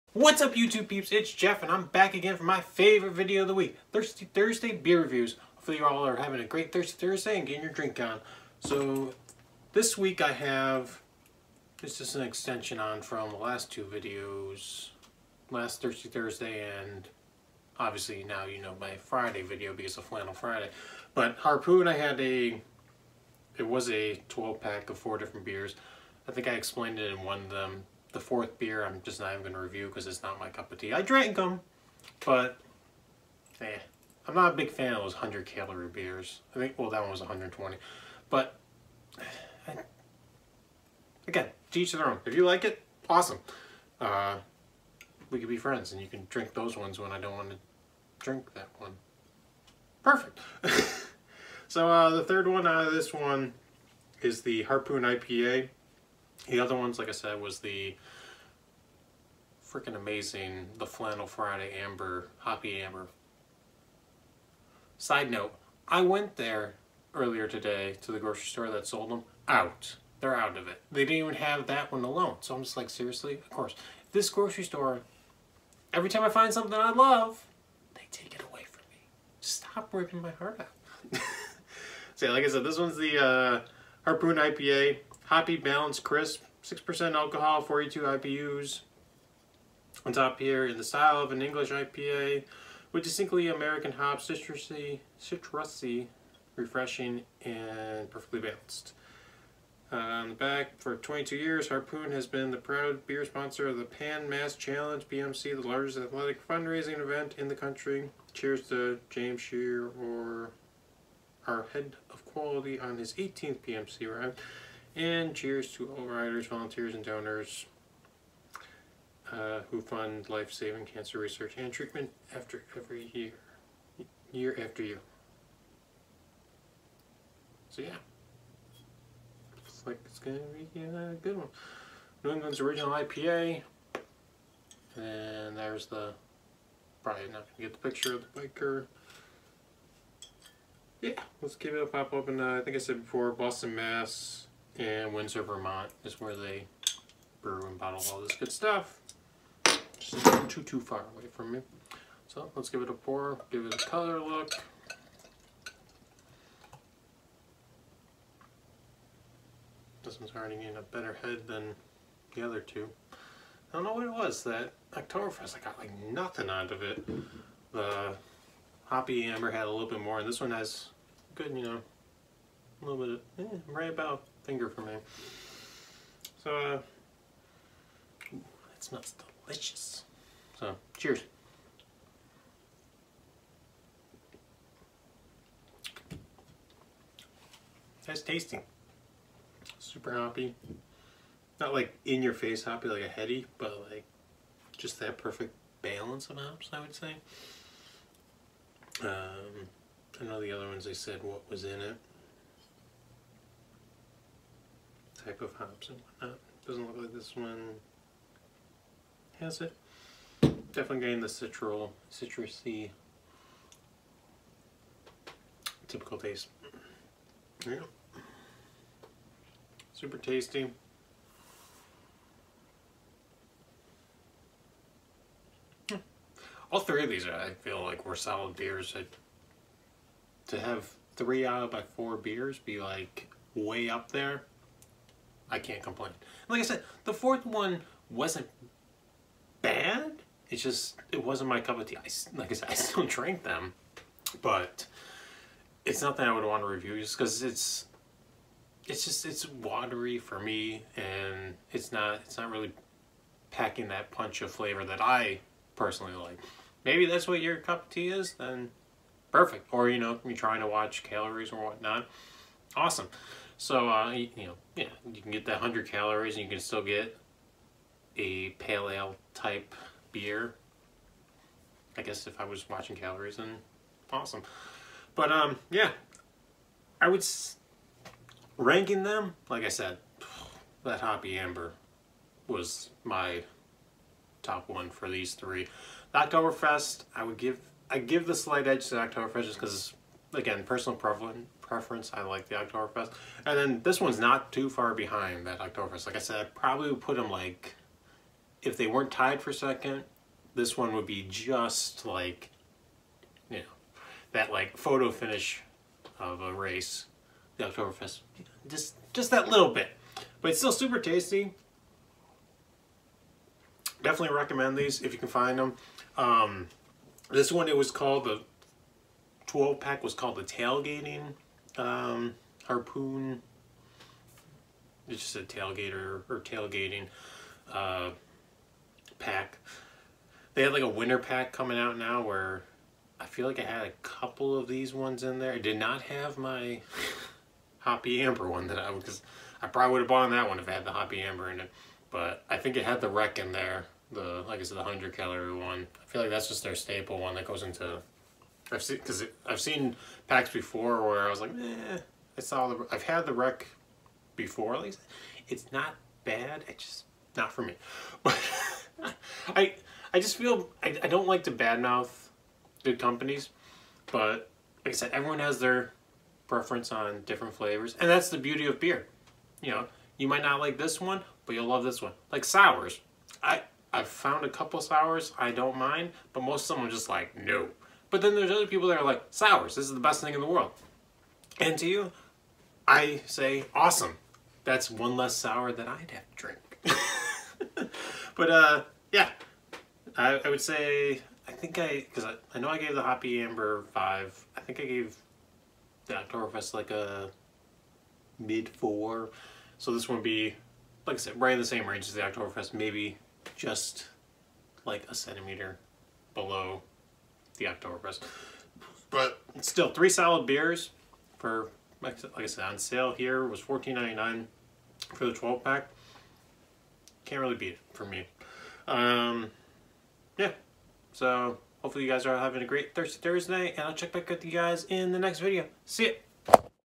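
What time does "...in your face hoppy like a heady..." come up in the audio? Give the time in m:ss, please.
3:12.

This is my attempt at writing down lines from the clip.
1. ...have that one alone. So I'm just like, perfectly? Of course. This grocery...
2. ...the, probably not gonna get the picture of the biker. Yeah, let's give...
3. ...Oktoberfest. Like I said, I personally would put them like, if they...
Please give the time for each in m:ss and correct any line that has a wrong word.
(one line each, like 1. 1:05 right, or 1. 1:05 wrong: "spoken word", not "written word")
1. 1:11 wrong: "seriously", not "perfectly"
2. 2:15 right
3. 4:55 wrong: "probably", not "personally".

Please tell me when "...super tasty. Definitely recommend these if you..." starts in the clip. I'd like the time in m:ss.
5:10.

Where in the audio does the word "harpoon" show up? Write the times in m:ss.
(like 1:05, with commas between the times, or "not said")
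0:21, 0:54, 1:24, 1:41, 5:22.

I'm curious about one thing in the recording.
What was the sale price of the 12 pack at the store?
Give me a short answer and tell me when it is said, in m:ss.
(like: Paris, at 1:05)
$14.99, at 6:53.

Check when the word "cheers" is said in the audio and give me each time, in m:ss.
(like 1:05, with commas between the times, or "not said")
1:48, 1:55, 3:00.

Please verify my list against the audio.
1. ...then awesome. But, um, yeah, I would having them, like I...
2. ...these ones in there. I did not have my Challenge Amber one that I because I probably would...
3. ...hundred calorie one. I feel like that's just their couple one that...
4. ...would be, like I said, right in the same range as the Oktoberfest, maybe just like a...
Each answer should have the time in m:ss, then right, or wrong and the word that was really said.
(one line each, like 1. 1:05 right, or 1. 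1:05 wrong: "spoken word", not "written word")
1. 4:33 wrong: "ranking", not "having"
2. 5:34 wrong: "Hoppy", not "Challenge"
3. 5:44 wrong: "staple", not "couple"
4. 6:40 right.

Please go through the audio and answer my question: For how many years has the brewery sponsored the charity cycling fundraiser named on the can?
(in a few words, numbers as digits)
22.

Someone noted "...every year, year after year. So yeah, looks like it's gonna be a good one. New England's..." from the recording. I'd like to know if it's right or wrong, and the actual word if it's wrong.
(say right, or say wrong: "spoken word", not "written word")
right.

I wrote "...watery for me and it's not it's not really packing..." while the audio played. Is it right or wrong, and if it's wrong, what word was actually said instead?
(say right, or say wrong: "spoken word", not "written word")
right.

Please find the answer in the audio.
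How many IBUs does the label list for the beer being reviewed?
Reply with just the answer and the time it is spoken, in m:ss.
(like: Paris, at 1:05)
42, at 1:27.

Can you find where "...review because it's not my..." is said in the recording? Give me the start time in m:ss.
0:29.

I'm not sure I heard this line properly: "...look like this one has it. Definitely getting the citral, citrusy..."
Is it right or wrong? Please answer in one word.
right.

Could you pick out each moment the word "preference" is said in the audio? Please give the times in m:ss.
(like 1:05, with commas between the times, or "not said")
4:50, 6:06.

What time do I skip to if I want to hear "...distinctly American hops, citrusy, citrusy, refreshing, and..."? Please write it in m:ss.
1:33.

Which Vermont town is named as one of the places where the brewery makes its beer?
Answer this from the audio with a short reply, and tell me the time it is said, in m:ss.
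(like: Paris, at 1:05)
Windsor, at 2:25.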